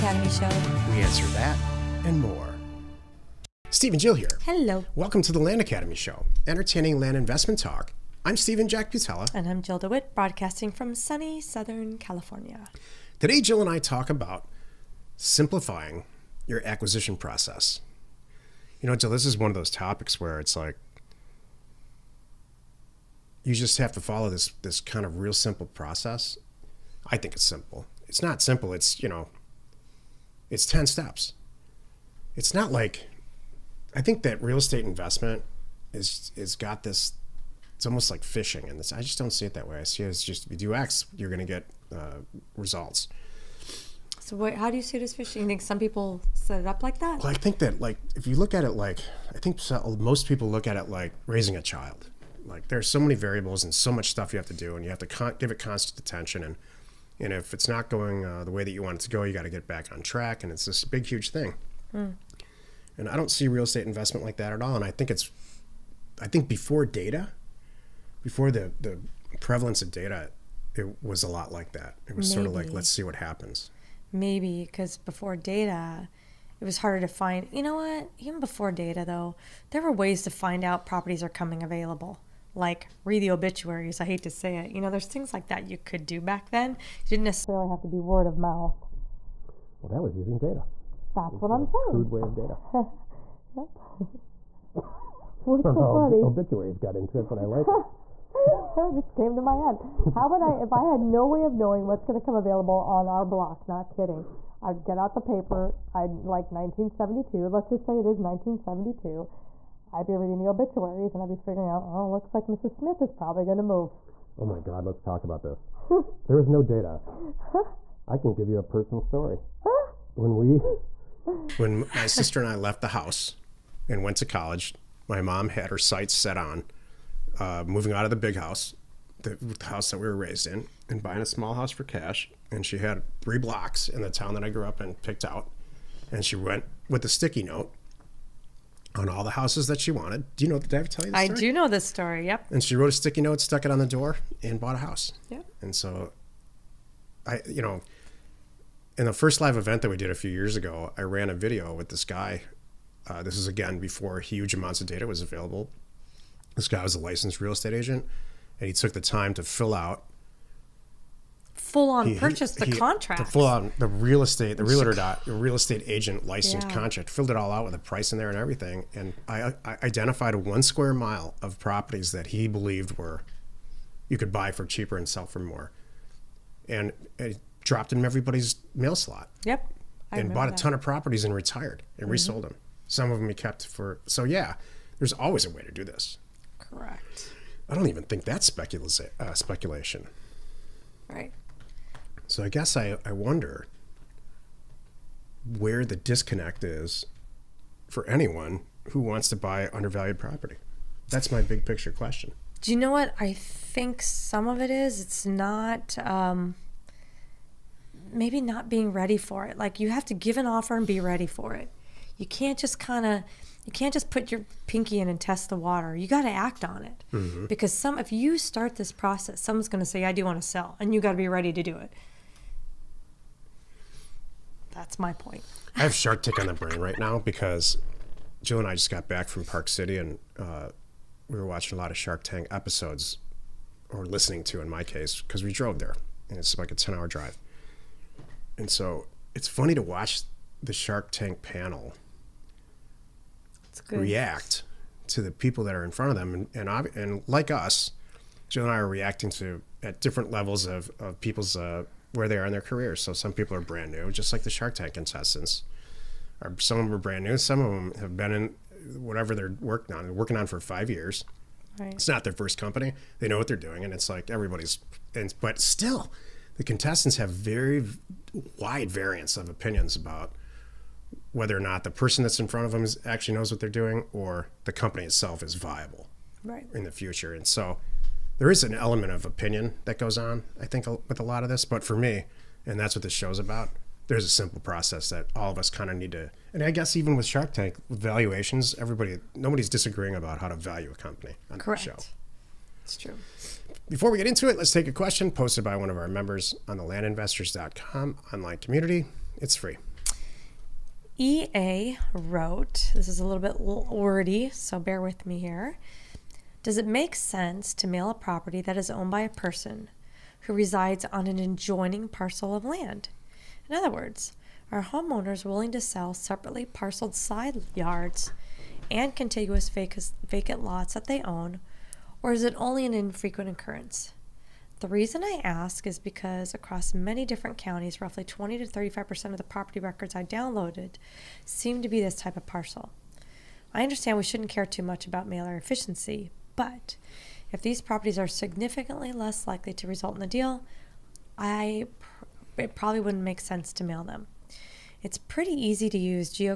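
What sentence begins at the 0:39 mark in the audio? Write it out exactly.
I see it as just if you do X, you're going to get uh, results.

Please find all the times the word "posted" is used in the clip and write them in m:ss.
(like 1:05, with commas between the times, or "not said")
4:55.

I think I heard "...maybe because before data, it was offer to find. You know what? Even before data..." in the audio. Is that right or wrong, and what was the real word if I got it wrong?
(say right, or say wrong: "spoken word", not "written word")
wrong: "harder", not "offer".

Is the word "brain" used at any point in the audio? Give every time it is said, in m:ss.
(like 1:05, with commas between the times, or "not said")
3:46.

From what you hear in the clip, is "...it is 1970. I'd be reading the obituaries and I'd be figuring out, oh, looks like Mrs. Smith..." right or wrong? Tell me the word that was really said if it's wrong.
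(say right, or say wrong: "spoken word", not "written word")
wrong: "1972", not "1970".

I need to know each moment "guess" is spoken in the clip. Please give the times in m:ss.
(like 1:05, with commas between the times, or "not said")
3:12, 4:46.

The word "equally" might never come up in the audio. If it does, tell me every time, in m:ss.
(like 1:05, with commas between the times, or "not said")
not said.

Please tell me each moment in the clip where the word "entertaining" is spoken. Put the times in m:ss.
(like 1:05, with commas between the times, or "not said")
0:06.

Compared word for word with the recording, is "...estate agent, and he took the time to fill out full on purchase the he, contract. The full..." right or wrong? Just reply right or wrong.
right.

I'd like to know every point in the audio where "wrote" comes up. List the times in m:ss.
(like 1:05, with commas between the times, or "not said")
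2:22, 5:02.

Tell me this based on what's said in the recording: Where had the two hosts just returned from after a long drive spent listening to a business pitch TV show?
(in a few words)
Park City.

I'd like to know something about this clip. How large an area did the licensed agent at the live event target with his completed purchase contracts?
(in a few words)
One square mile.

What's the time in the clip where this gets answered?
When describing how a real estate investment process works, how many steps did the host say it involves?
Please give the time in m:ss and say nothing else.
0:30.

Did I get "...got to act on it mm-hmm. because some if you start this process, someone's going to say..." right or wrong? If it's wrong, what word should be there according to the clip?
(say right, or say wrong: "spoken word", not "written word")
right.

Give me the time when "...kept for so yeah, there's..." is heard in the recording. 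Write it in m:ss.
3:03.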